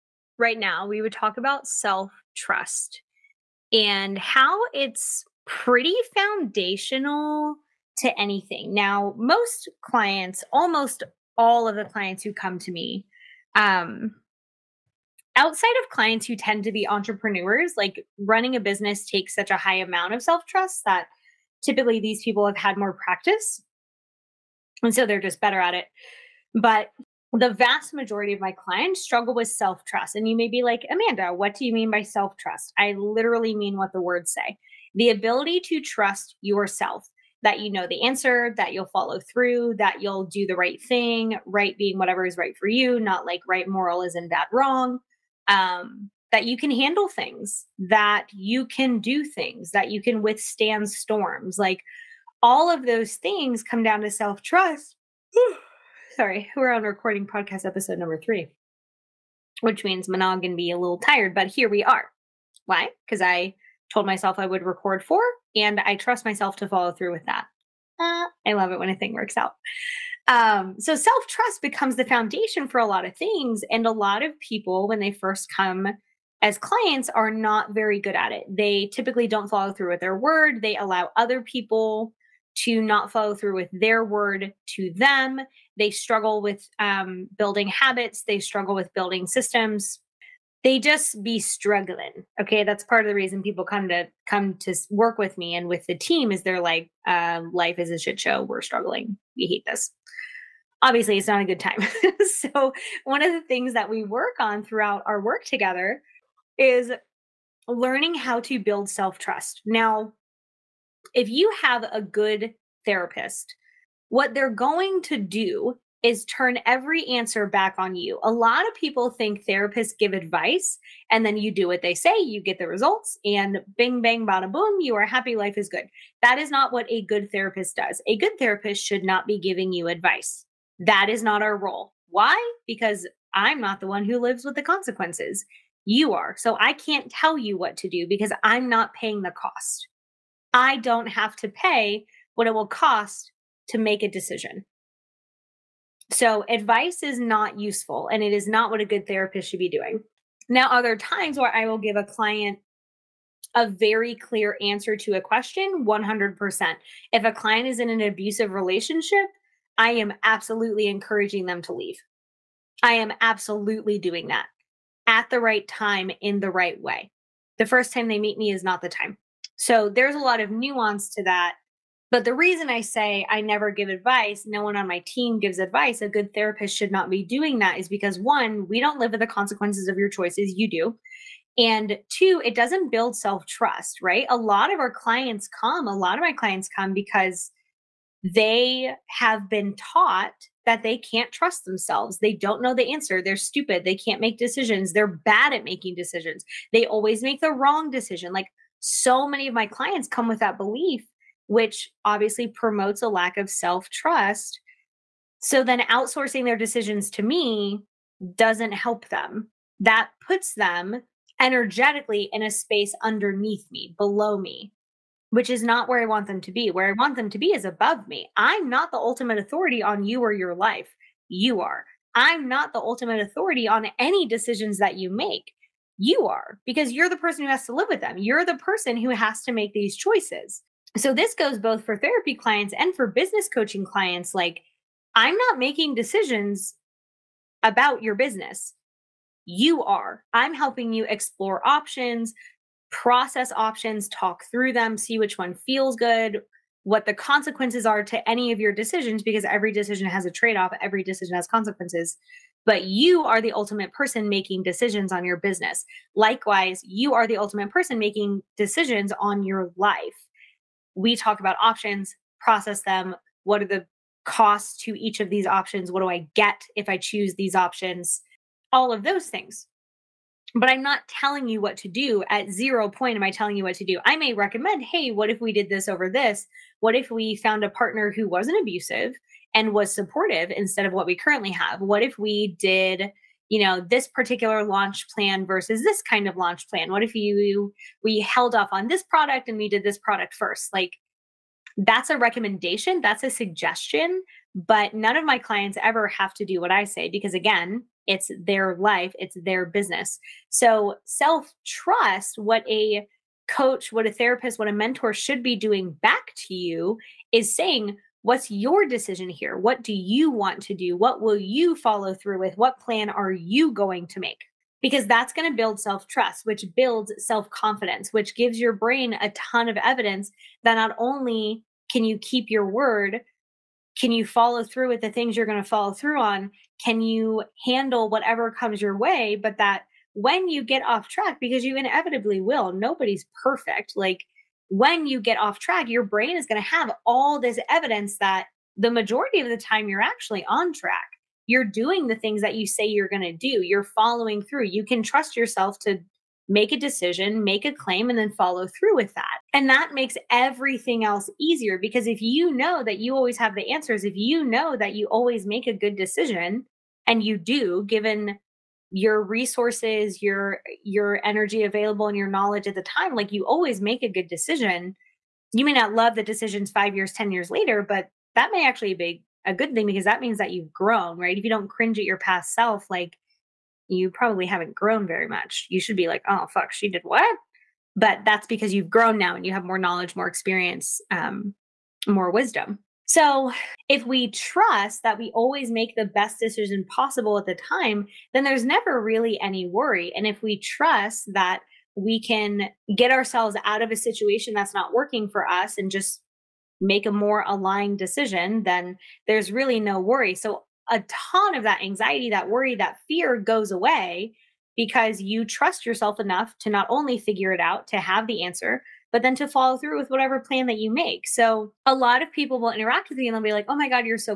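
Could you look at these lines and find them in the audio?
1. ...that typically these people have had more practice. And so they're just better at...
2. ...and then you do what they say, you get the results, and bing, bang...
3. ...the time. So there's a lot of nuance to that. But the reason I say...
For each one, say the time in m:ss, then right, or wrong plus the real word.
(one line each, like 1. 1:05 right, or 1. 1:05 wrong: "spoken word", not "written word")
1. 0:20 right
2. 2:01 right
3. 2:48 right.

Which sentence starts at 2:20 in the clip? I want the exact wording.
I don't have to pay what it will cost to make a decision.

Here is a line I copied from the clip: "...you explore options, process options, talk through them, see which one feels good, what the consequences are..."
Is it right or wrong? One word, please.
right.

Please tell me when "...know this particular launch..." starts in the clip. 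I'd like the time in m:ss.
4:43.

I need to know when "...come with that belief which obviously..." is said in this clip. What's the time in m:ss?
3:20.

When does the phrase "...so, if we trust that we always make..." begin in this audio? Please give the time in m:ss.
6:23.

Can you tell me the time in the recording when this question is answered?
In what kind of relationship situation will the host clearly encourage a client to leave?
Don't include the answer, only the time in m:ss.
2:38.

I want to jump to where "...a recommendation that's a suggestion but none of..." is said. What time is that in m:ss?
4:52.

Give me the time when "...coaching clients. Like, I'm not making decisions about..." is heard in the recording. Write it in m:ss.
3:53.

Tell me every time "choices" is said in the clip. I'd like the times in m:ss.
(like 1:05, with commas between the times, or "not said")
3:00, 3:49.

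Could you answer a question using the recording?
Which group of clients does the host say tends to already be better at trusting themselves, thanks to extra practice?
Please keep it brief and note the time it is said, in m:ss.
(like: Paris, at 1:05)
entrepreneurs, at 0:16.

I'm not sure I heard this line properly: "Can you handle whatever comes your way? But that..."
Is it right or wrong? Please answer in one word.
right.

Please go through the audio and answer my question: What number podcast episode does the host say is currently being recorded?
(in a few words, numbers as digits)
3.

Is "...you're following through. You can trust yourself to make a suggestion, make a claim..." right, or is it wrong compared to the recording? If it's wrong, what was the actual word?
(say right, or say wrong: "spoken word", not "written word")
wrong: "decision", not "suggestion".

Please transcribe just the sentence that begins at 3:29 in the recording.
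That puts them energetically in a space underneath me, below me, which is not where I want them to be.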